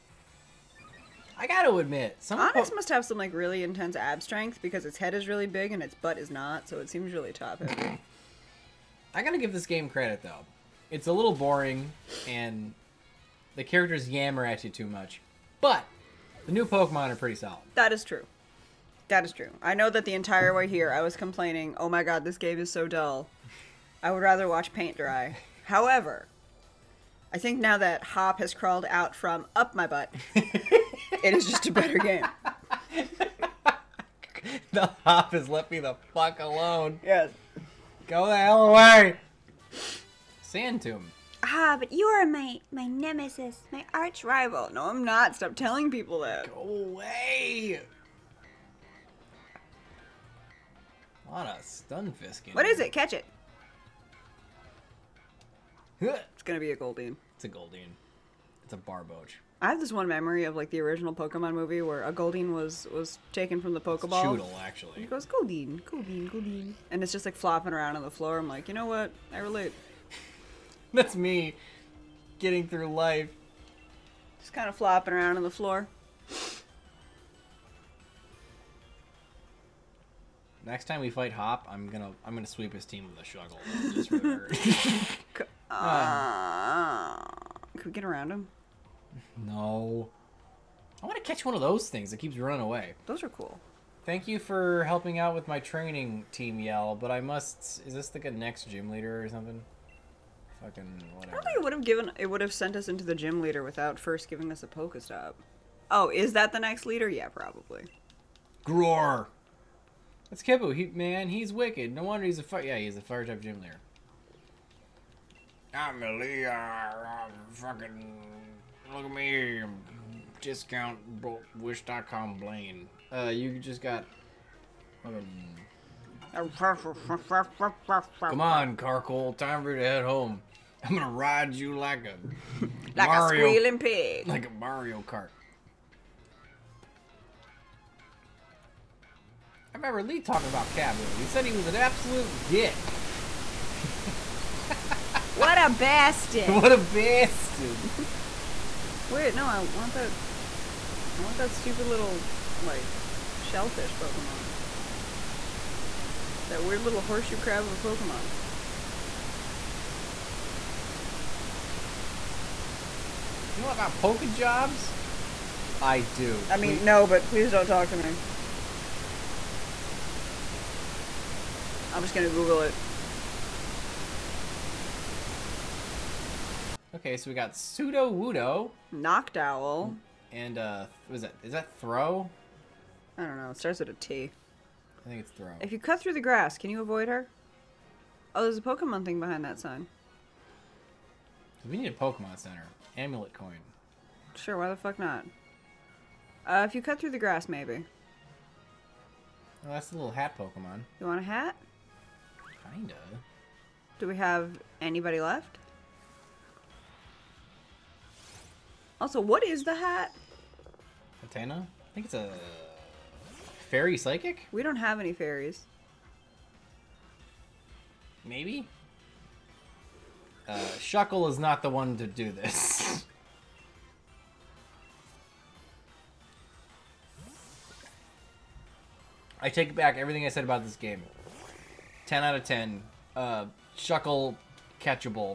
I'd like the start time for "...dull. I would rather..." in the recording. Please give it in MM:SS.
00:22.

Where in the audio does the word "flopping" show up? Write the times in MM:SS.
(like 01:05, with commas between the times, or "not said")
01:07, 01:14.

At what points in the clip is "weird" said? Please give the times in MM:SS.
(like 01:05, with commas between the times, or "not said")
02:36.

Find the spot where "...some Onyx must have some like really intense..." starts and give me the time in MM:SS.
00:02.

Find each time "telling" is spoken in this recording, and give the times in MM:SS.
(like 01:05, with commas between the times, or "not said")
00:45.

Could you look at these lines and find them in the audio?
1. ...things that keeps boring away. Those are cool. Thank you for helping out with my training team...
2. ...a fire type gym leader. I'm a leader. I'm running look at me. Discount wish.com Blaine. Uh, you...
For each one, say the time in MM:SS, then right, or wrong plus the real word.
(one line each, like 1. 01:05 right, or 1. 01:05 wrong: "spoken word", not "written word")
1. 01:31 wrong: "running", not "boring"
2. 01:52 wrong: "fucking", not "running".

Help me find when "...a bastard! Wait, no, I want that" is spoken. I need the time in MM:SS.
02:26.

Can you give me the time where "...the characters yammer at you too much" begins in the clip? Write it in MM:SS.
00:13.